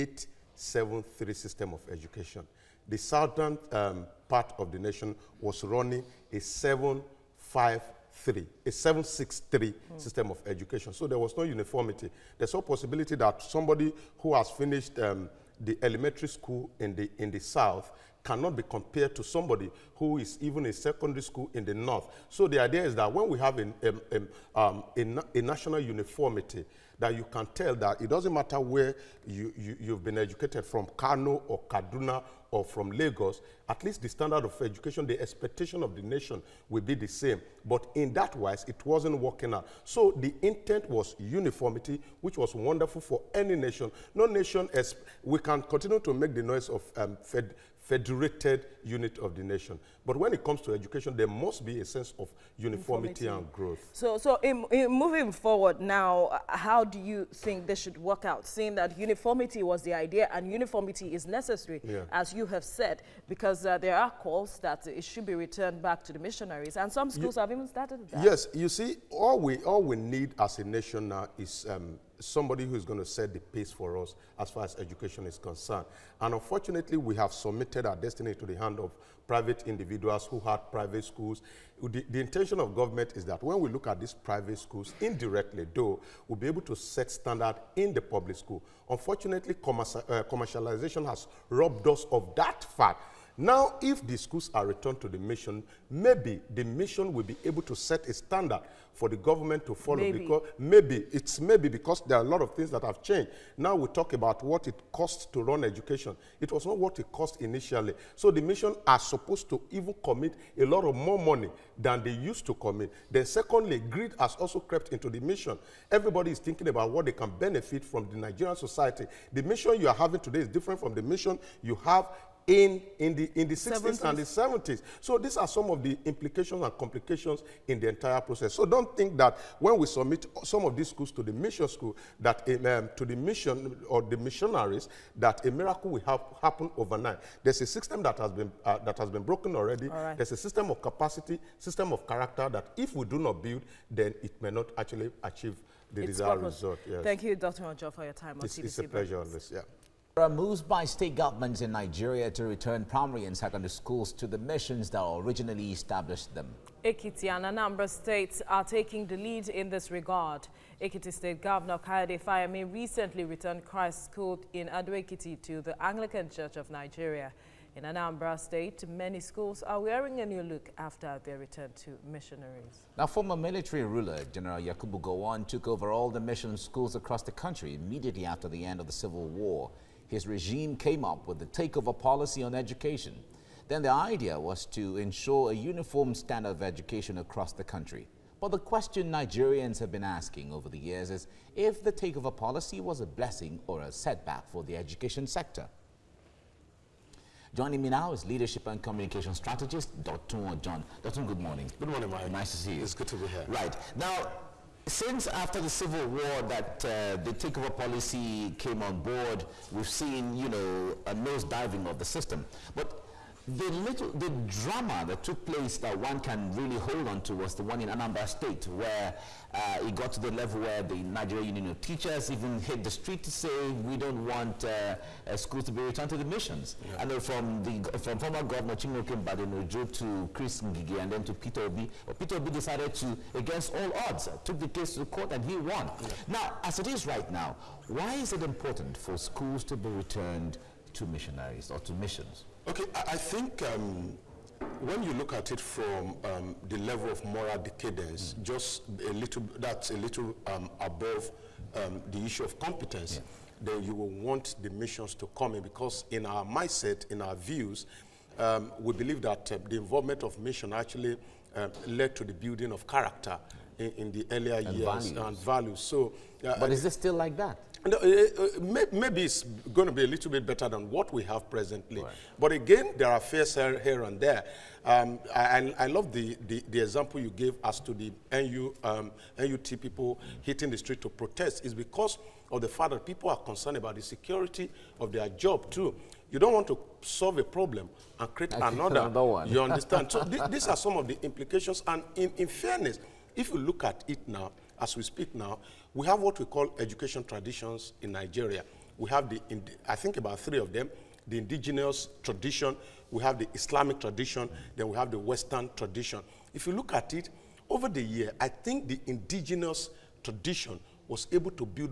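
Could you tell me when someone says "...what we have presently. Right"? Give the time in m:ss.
4:30.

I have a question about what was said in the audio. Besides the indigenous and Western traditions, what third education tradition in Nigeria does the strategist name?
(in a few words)
Islamic tradition.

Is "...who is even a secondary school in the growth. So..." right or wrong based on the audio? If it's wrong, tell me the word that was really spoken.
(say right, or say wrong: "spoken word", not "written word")
wrong: "north", not "growth".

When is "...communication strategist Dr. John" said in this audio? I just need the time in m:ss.
3:18.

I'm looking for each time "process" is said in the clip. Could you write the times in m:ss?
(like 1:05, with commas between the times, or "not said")
2:08.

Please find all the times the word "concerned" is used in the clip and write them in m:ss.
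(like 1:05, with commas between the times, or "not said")
1:15, 4:43.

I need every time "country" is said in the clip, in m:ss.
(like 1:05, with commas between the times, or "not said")
2:57, 3:07.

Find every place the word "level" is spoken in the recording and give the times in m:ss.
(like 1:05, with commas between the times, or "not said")
3:40, 4:06.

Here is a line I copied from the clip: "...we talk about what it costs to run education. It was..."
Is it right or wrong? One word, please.
right.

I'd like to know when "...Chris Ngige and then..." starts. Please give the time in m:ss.
3:50.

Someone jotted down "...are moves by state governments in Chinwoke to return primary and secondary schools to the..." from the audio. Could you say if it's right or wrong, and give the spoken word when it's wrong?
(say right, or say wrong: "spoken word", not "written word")
wrong: "Nigeria", not "Chinwoke".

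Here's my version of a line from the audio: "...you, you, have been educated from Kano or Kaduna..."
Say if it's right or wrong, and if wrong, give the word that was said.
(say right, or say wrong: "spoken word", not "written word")
right.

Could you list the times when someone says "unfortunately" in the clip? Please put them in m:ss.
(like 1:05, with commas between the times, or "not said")
1:16, 1:28.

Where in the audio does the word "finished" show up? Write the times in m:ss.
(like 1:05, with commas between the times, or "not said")
0:14.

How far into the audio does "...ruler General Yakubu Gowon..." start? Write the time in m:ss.
2:53.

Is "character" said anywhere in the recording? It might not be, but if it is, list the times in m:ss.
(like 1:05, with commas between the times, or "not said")
2:22, 4:22.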